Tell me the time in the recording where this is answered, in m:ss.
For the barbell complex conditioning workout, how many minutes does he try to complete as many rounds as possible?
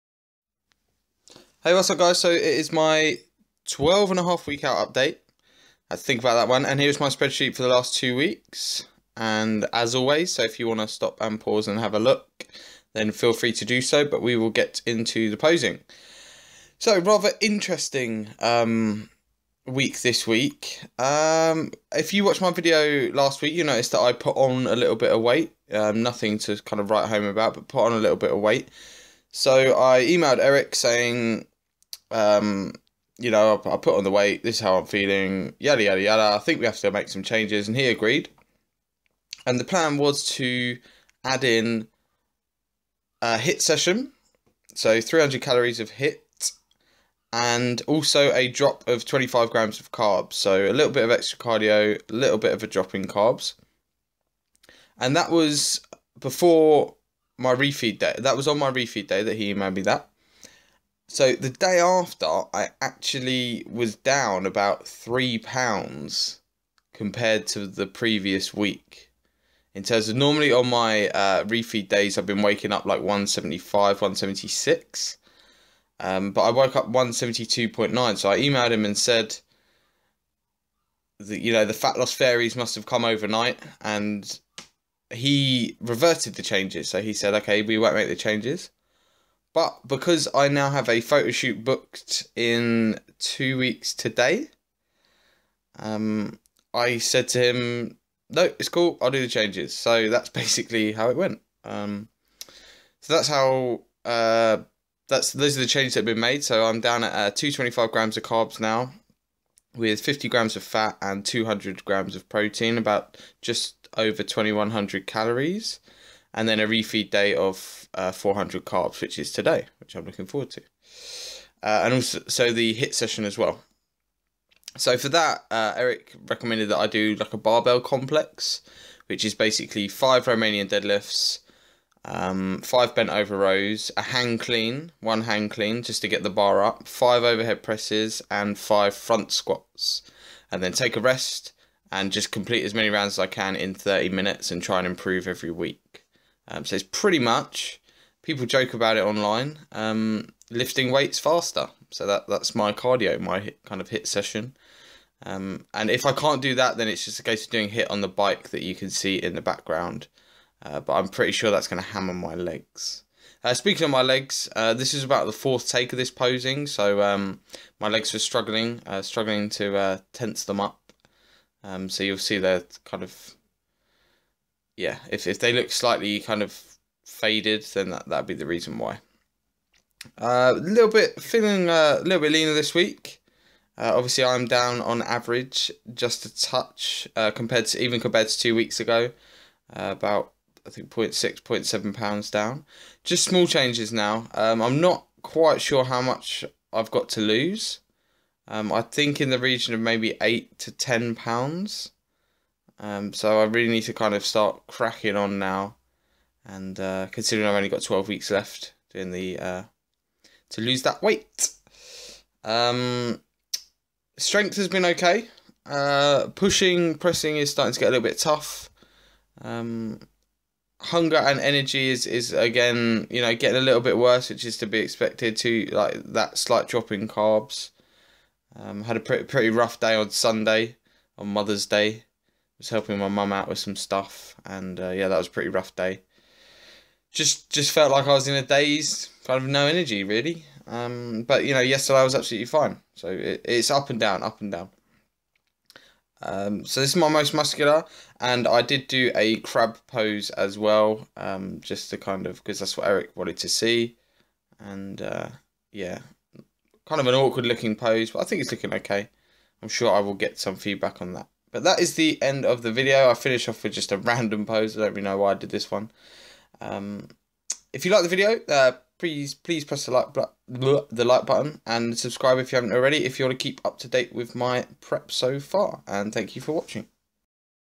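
2:23.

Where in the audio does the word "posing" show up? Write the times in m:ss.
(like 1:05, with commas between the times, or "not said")
0:15, 2:46.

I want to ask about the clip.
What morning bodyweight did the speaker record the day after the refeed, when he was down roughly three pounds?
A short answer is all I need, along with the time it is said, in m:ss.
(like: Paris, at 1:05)
172.9, at 1:16.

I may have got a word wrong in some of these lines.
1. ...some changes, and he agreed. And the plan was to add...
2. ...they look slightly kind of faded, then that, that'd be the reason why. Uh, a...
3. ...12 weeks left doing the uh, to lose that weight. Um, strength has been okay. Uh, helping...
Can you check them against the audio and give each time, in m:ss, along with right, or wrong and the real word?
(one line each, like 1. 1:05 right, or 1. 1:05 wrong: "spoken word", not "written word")
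1. 0:37 right
2. 2:55 right
3. 3:27 wrong: "pushing", not "helping".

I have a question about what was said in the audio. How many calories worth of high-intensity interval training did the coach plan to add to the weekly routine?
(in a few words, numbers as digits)
300.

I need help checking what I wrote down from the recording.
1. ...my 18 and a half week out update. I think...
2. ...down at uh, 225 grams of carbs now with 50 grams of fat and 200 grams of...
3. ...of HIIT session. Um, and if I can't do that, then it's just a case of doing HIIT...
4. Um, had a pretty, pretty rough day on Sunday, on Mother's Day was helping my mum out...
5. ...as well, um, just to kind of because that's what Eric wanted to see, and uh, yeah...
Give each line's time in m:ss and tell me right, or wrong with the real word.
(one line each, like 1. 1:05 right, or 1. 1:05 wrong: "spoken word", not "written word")
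1. 0:02 wrong: "12", not "18"
2. 1:46 right
3. 2:33 right
4. 3:48 right
5. 4:10 right.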